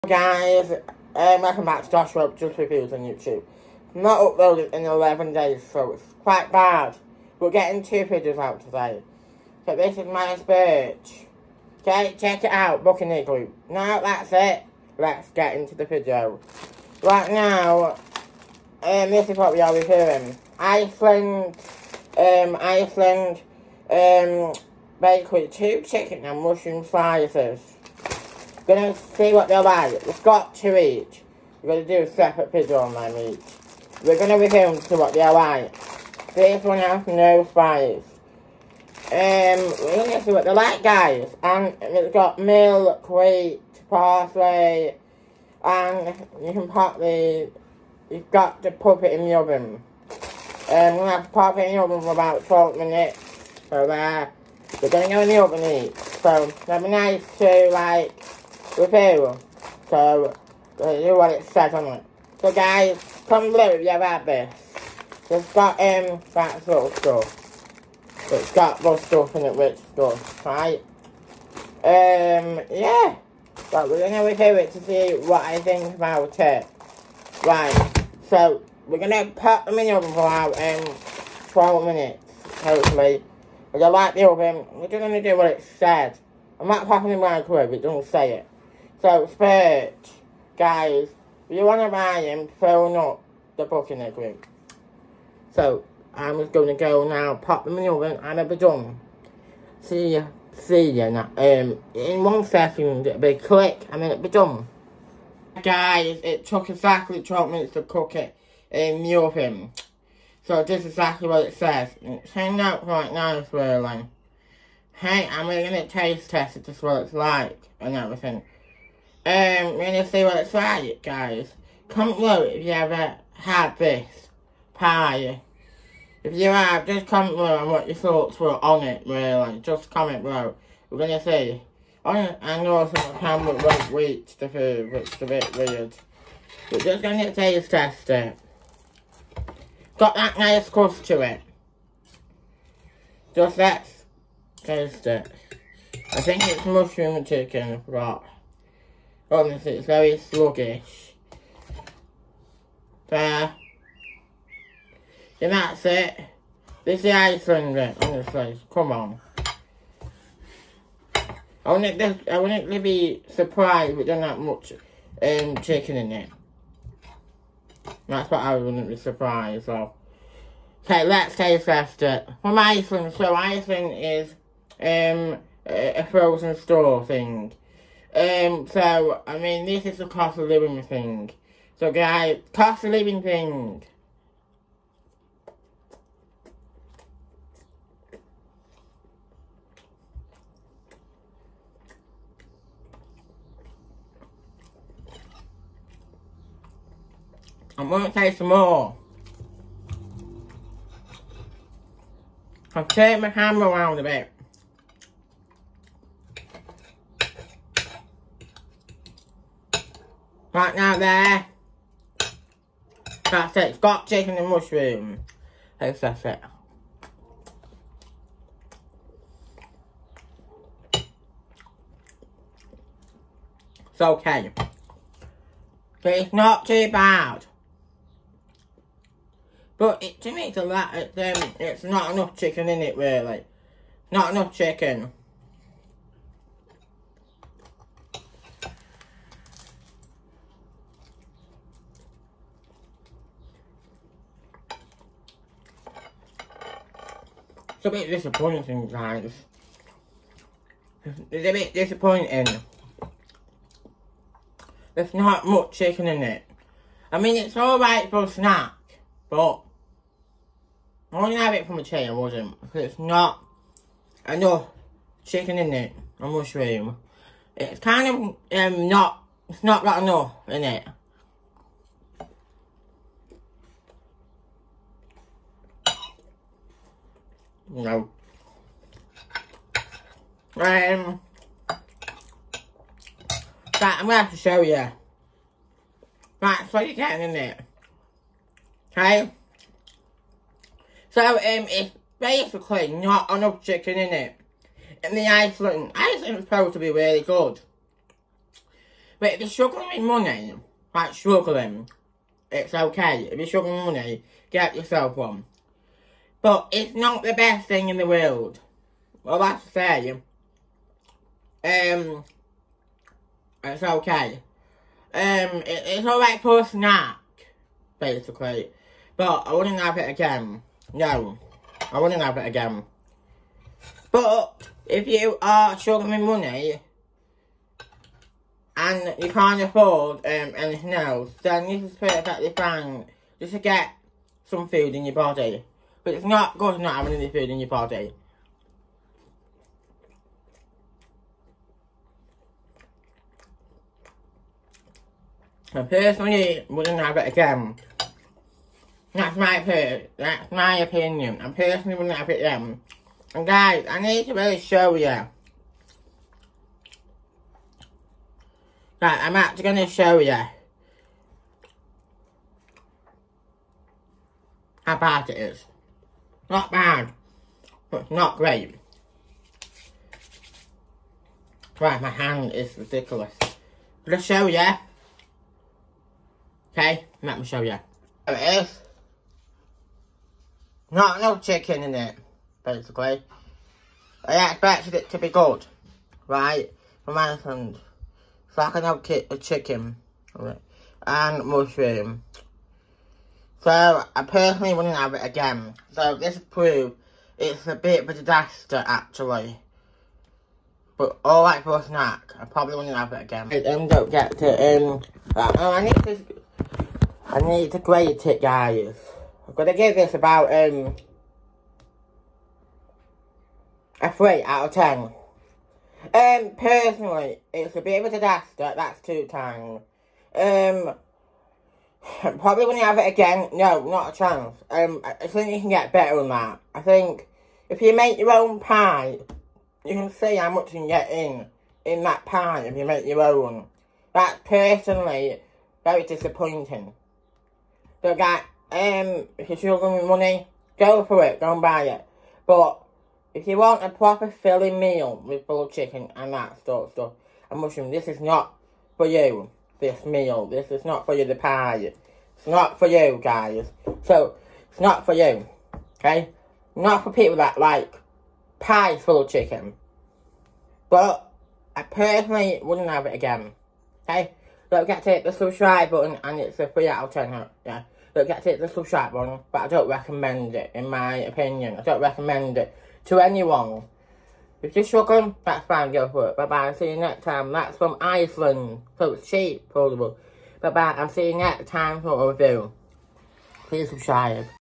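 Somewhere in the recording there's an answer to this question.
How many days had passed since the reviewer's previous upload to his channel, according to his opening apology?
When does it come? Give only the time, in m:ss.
0:04.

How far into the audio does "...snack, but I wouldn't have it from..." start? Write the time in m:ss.
4:18.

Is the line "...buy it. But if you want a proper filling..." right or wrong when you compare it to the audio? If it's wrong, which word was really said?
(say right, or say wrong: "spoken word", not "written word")
right.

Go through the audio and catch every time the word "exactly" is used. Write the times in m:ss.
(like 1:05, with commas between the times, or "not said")
1:46, 1:50.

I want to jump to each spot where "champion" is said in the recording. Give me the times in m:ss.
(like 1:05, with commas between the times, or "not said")
not said.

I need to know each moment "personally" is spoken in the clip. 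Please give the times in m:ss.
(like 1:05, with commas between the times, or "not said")
5:45, 5:51, 6:34, 6:56, 7:14, 7:41.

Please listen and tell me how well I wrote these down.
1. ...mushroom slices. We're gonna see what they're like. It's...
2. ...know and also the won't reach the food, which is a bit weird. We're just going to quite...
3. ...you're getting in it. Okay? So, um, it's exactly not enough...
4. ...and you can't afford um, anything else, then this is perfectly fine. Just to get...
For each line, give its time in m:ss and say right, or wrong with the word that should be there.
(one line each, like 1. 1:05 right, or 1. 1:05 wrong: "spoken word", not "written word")
1. 0:26 right
2. 2:12 wrong: "taste", not "quite"
3. 4:46 wrong: "basically", not "exactly"
4. 5:28 right.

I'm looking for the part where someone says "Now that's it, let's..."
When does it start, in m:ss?
0:13.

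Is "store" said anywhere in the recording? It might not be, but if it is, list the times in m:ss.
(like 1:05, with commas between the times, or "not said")
2:56.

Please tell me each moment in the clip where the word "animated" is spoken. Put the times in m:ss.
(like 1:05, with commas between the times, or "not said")
not said.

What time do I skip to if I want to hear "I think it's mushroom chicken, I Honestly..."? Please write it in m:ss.
2:26.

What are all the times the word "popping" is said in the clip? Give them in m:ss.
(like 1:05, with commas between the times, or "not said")
1:26.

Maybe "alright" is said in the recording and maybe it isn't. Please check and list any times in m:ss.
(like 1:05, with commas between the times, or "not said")
4:17, 5:16.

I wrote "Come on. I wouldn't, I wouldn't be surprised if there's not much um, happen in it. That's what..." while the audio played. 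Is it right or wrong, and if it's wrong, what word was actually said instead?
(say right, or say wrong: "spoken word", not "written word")
wrong: "chicken", not "happen".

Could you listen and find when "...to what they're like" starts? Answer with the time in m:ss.
0:34.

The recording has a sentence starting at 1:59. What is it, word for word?
Um, are gonna see what it's like, guys, comment below if you ever had this pie.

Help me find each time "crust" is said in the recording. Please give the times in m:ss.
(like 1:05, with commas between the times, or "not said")
2:20.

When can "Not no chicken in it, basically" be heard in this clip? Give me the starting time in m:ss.
6:20.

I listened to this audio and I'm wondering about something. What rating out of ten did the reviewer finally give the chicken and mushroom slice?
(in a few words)
3.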